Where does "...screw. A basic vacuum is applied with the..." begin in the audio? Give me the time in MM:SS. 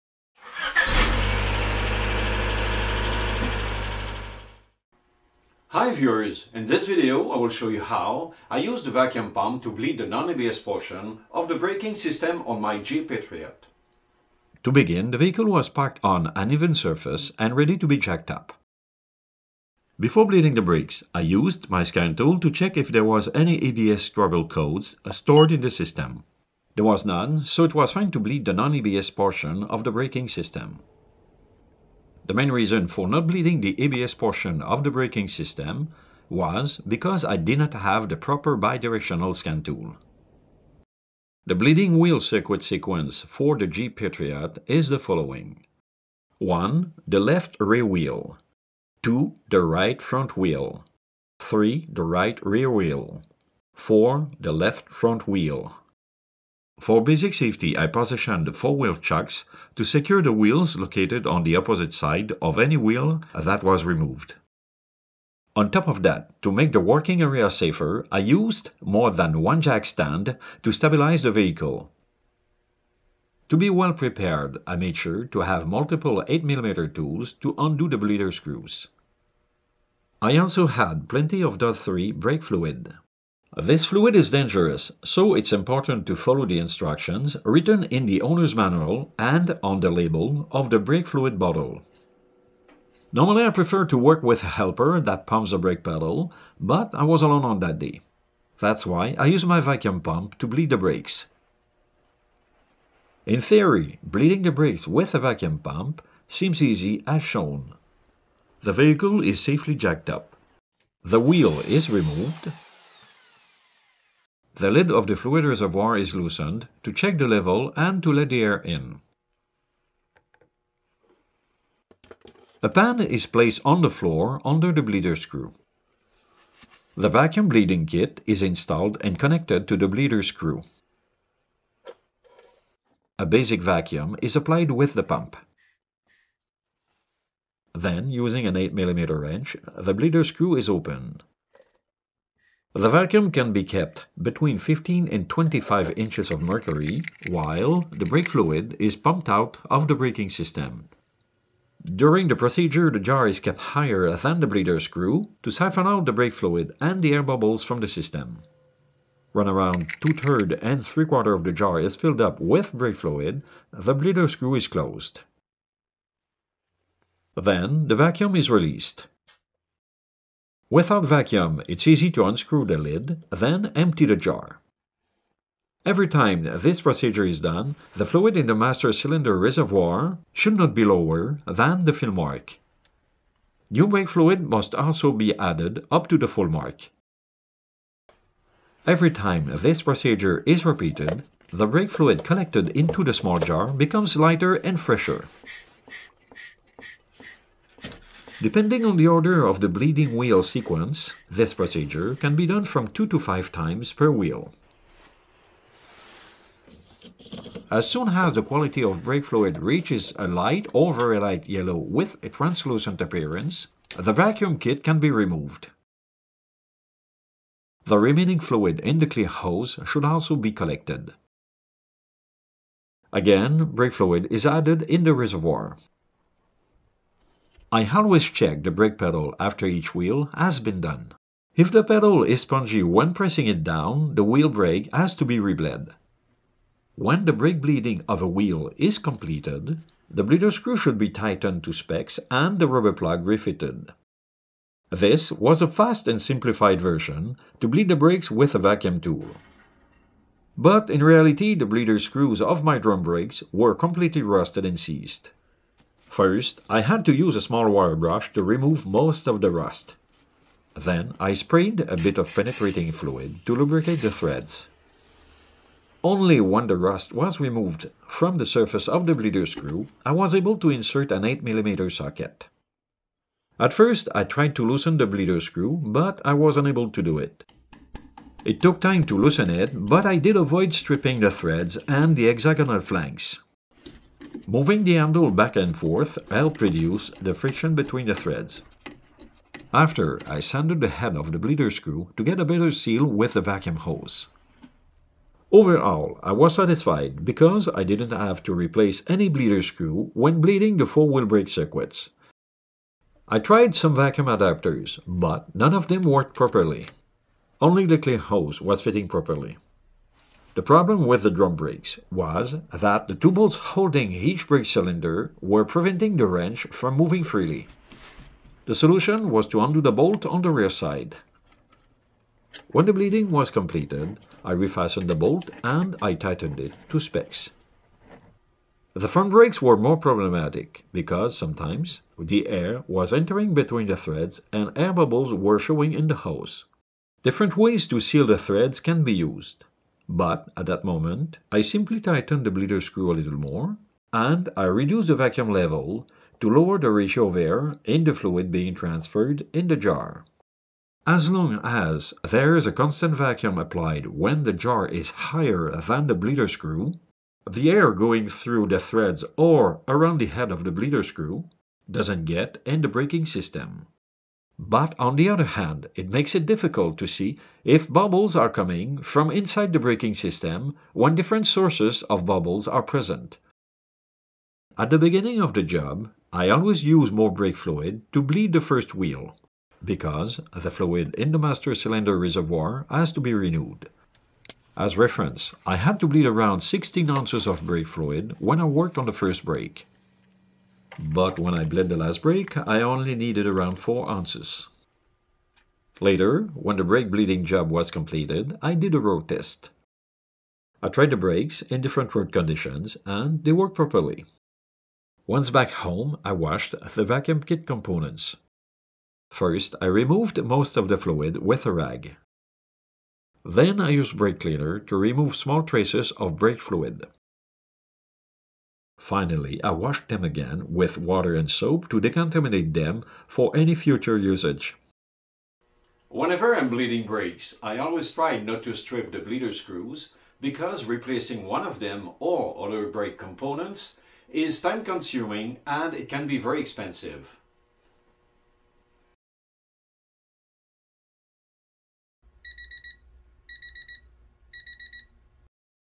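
02:10.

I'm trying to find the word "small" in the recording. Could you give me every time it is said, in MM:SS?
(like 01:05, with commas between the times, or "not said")
03:13, 04:17, 06:55.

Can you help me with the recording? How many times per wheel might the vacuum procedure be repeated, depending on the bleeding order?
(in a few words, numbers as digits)
2 to 5 times.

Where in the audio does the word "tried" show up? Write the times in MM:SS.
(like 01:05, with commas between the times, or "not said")
04:34, 05:03, 06:40.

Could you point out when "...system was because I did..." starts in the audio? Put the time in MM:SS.
00:35.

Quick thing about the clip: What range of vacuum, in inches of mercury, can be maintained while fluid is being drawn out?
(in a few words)
15 to 25.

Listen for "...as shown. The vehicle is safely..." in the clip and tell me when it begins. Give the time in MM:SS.
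01:47.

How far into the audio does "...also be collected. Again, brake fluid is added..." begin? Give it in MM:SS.
03:40.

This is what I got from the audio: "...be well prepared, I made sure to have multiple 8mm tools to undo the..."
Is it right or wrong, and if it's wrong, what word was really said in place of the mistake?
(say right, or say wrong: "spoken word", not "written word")
right.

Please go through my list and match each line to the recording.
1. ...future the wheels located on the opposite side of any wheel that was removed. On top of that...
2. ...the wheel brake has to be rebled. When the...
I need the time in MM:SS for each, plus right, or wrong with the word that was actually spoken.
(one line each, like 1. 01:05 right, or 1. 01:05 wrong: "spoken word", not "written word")
1. 00:59 wrong: "secure", not "future"
2. 03:54 right.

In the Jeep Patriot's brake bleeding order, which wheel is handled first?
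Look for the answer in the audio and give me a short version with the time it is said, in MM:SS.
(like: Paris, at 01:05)
Left rear wheel, at 00:47.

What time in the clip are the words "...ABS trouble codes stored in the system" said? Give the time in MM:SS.
00:23.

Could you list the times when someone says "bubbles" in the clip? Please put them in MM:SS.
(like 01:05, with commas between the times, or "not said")
02:37, 05:34, 06:07, 06:12.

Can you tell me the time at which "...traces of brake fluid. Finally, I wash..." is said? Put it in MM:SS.
06:55.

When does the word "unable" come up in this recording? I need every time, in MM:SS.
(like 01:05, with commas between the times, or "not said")
04:36.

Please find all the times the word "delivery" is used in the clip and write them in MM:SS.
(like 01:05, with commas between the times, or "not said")
not said.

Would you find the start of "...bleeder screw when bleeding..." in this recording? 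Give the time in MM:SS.
04:59.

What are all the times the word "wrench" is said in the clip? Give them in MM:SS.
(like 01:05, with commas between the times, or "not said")
02:19, 05:16.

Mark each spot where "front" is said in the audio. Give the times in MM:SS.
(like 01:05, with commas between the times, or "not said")
00:50, 00:54, 05:29.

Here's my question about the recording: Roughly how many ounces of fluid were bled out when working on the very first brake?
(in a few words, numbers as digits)
16 ounces.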